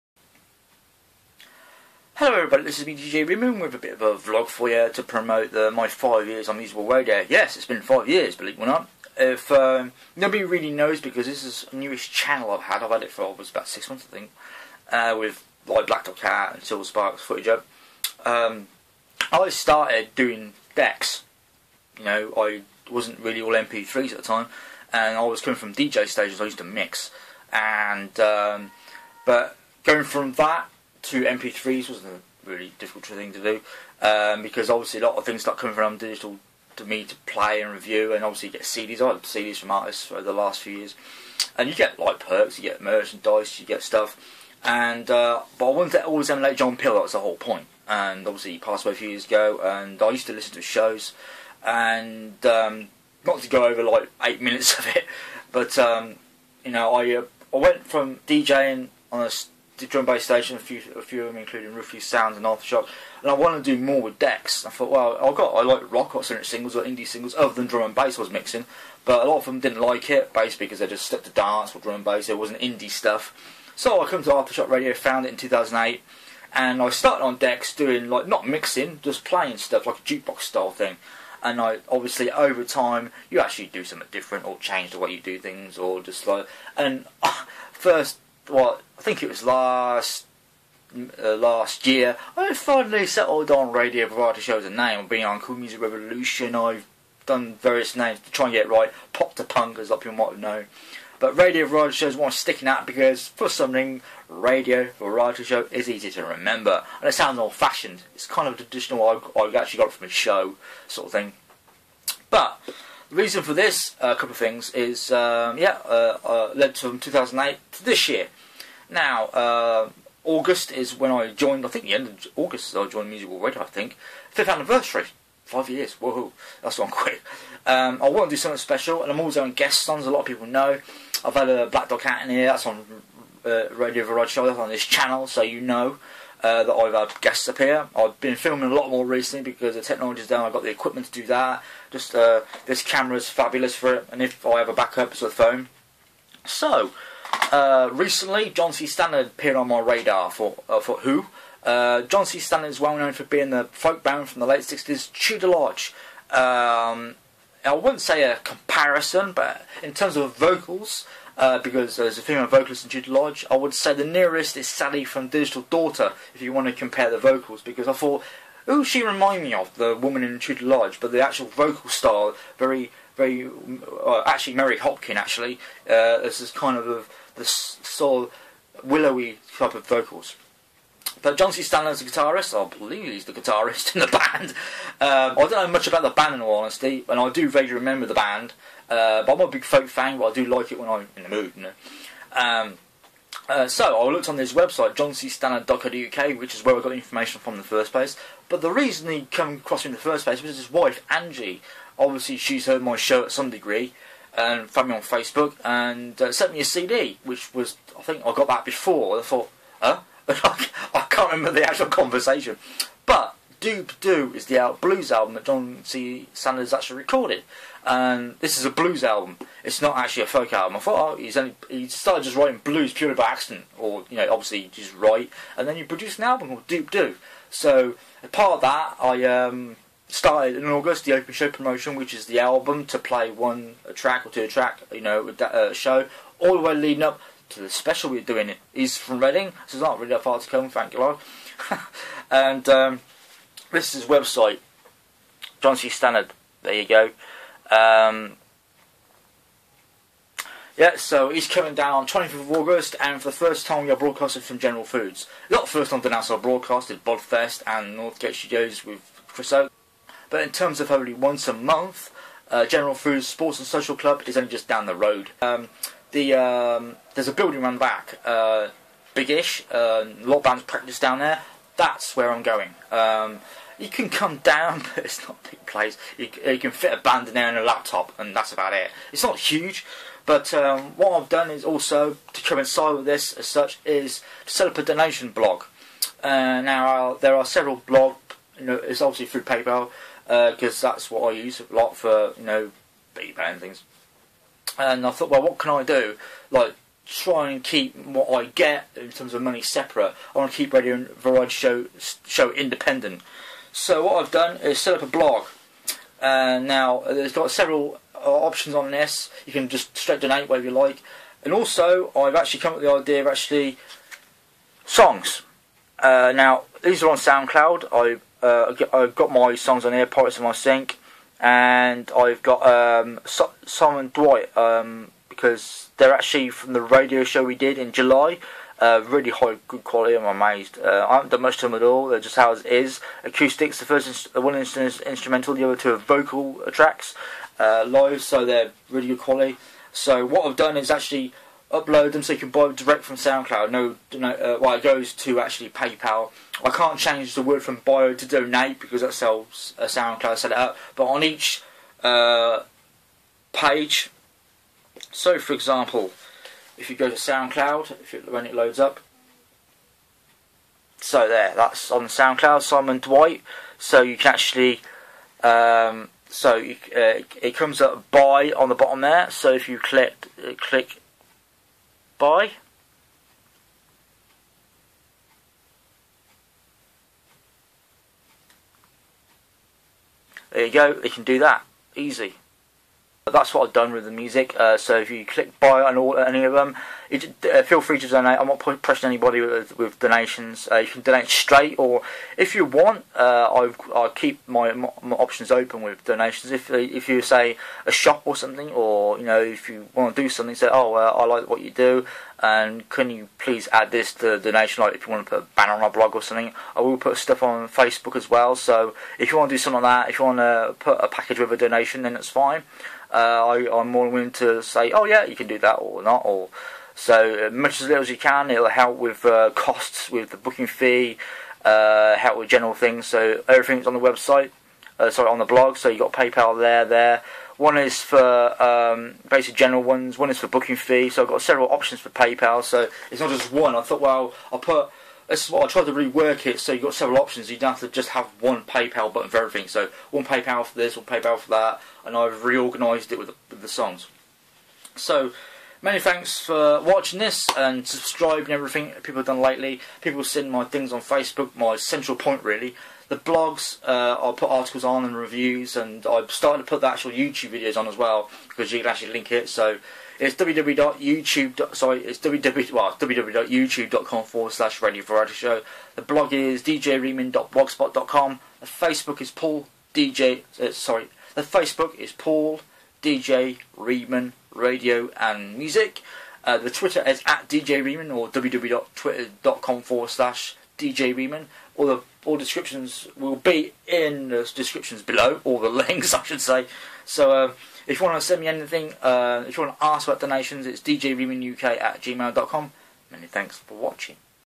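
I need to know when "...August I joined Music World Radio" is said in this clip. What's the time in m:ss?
2:02.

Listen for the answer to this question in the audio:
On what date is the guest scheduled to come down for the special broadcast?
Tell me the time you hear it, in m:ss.
4:12.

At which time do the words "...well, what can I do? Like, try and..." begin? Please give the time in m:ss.
4:55.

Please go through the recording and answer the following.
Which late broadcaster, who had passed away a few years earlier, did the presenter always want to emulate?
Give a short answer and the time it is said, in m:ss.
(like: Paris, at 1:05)
John Peel, at 0:46.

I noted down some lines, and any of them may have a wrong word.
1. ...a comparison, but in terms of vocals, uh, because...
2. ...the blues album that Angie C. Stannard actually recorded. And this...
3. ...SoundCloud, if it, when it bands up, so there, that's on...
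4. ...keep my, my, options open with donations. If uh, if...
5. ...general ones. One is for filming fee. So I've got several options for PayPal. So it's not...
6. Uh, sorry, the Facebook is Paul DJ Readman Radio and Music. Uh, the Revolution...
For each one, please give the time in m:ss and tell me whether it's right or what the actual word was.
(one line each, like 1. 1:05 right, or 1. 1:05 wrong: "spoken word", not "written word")
1. 2:38 right
2. 3:34 wrong: "John", not "Angie"
3. 5:57 wrong: "loads", not "bands"
4. 6:34 right
5. 7:09 wrong: "booking", not "filming"
6. 7:50 wrong: "Twitter", not "Revolution".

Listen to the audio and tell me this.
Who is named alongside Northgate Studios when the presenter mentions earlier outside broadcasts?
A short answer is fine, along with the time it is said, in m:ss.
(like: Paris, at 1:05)
Chris Oak, at 4:19.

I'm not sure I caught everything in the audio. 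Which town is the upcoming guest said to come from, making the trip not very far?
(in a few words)
Reading.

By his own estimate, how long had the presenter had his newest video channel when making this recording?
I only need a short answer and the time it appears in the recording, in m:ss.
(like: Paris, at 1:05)
about six months, at 0:13.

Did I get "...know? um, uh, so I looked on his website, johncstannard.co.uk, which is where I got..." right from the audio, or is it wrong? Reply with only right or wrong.
right.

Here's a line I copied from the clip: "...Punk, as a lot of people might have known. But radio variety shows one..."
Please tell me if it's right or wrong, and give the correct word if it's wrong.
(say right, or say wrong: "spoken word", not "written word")
right.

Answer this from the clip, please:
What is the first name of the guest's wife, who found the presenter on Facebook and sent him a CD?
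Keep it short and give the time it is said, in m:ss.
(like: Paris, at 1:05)
Angie, at 3:21.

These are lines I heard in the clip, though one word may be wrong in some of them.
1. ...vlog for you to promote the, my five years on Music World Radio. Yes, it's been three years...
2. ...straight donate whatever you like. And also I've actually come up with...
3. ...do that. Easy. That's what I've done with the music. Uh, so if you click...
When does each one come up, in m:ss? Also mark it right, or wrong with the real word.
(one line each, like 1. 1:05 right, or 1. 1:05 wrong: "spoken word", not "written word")
1. 0:04 wrong: "five", not "three"
2. 5:09 right
3. 6:21 right.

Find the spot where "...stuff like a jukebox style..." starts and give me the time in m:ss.
1:19.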